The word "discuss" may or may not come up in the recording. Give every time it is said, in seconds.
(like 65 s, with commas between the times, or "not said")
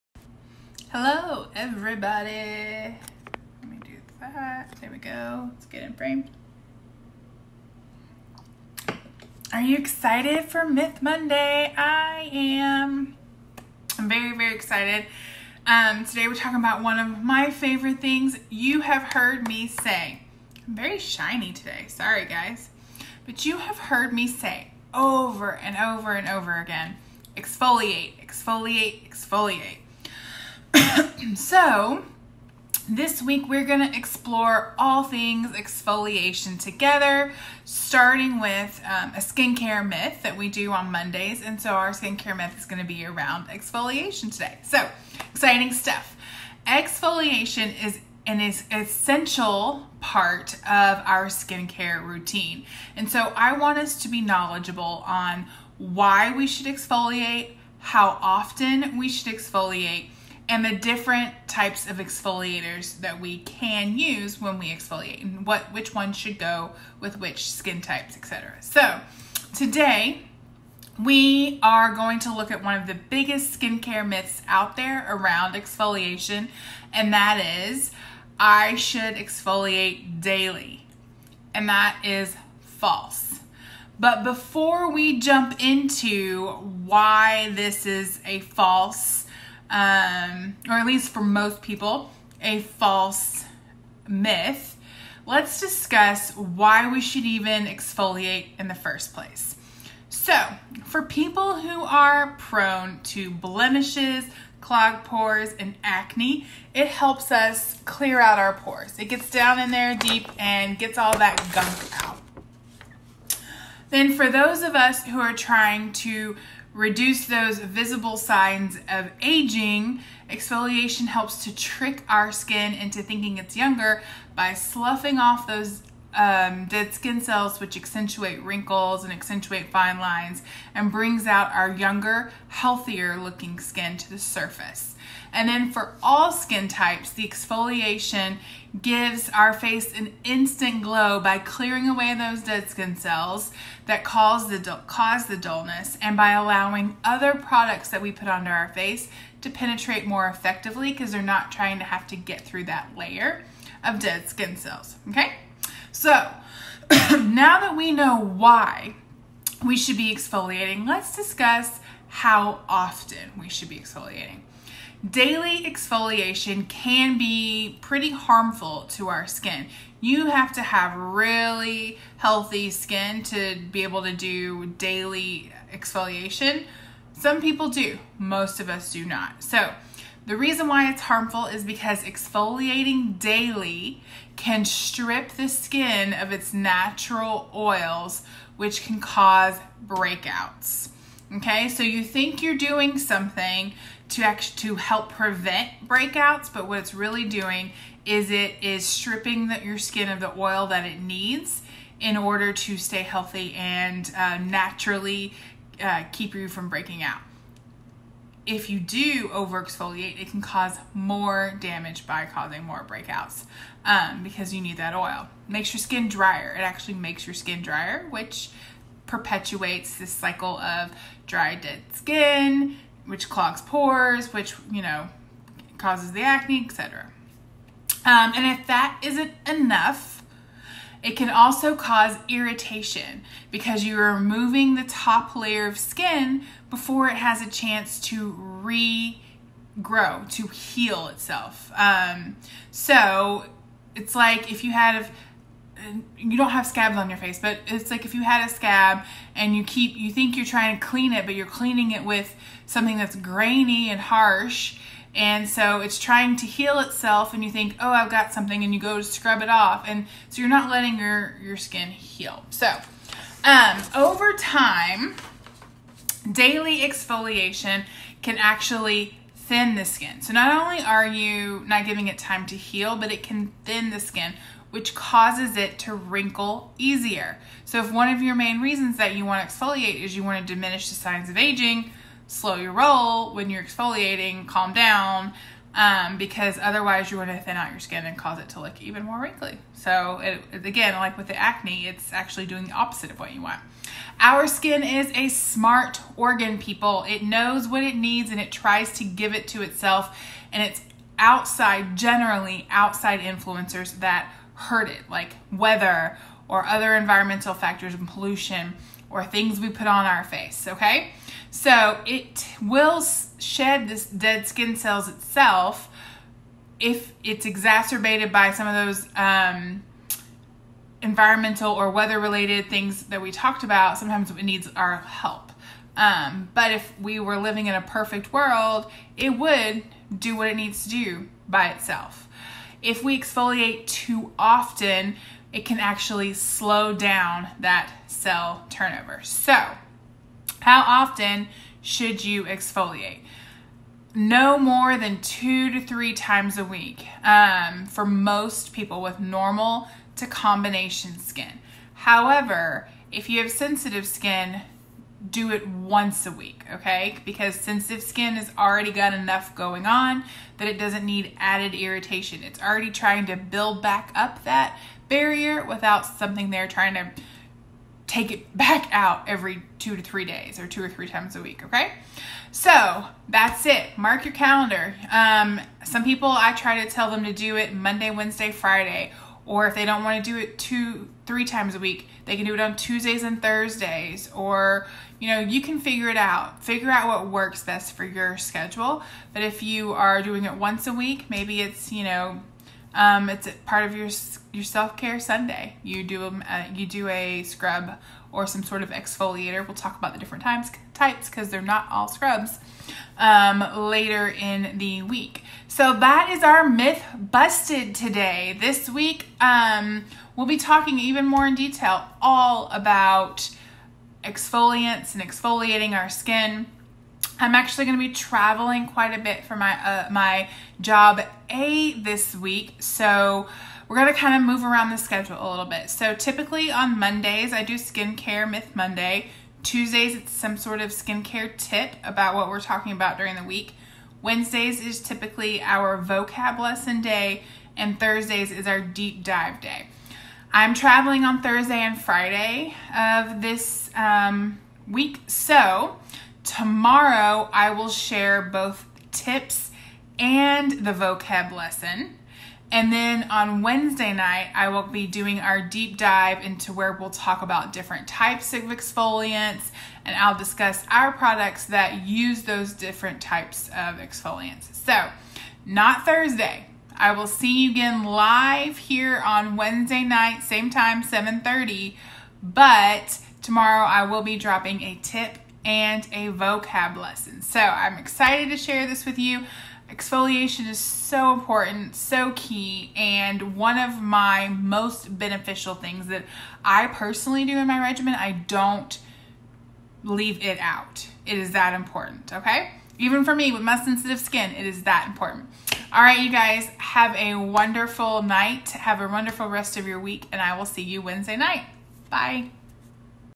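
95 s, 161 s, 460 s.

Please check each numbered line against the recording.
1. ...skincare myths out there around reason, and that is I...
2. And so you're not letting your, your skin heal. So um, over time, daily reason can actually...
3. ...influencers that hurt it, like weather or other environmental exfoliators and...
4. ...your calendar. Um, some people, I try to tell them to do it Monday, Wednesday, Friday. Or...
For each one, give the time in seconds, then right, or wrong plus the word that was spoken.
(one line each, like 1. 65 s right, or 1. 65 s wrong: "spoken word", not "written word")
1. 73 s wrong: "exfoliation", not "reason"
2. 259 s wrong: "exfoliation", not "reason"
3. 303 s wrong: "factors", not "exfoliators"
4. 374 s right.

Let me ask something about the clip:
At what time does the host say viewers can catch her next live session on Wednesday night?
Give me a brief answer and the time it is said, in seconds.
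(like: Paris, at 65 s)
7:30, at 471 s.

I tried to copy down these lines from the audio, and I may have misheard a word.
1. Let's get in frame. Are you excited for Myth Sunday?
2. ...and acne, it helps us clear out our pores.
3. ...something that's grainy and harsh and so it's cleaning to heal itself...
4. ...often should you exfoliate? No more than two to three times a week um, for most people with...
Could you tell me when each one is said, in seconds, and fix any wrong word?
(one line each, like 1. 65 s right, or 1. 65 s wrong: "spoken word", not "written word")
1. 5 s wrong: "Monday", not "Sunday"
2. 105 s right
3. 252 s wrong: "trying", not "cleaning"
4. 340 s right.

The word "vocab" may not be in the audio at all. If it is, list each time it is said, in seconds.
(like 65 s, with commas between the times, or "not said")
435 s, 450 s, 476 s.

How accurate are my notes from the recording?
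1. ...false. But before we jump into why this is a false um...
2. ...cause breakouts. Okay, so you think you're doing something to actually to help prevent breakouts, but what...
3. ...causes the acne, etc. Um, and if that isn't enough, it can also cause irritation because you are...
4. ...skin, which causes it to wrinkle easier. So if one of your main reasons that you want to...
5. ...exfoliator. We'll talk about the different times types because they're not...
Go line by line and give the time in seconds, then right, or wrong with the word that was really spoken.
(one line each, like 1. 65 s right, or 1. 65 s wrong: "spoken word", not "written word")
1. 82 s right
2. 188 s right
3. 225 s right
4. 273 s right
5. 398 s right.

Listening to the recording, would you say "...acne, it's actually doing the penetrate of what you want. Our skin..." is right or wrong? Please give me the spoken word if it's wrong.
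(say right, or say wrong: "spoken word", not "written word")
wrong: "opposite", not "penetrate".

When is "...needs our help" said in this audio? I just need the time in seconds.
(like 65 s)
324 s.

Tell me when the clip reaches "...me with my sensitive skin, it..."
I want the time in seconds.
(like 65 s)
493 s.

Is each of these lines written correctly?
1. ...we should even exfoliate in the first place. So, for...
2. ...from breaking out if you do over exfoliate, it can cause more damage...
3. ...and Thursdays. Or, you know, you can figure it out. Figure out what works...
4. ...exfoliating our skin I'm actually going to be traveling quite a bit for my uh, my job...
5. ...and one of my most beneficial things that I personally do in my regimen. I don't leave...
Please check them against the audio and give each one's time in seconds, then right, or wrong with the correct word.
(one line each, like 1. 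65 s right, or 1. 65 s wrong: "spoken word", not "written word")
1. 96 s right
2. 206 s right
3. 383 s right
4. 415 s right
5. 482 s right.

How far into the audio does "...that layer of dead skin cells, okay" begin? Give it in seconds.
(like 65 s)
152 s.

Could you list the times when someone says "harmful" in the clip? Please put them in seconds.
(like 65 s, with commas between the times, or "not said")
168 s, 181 s.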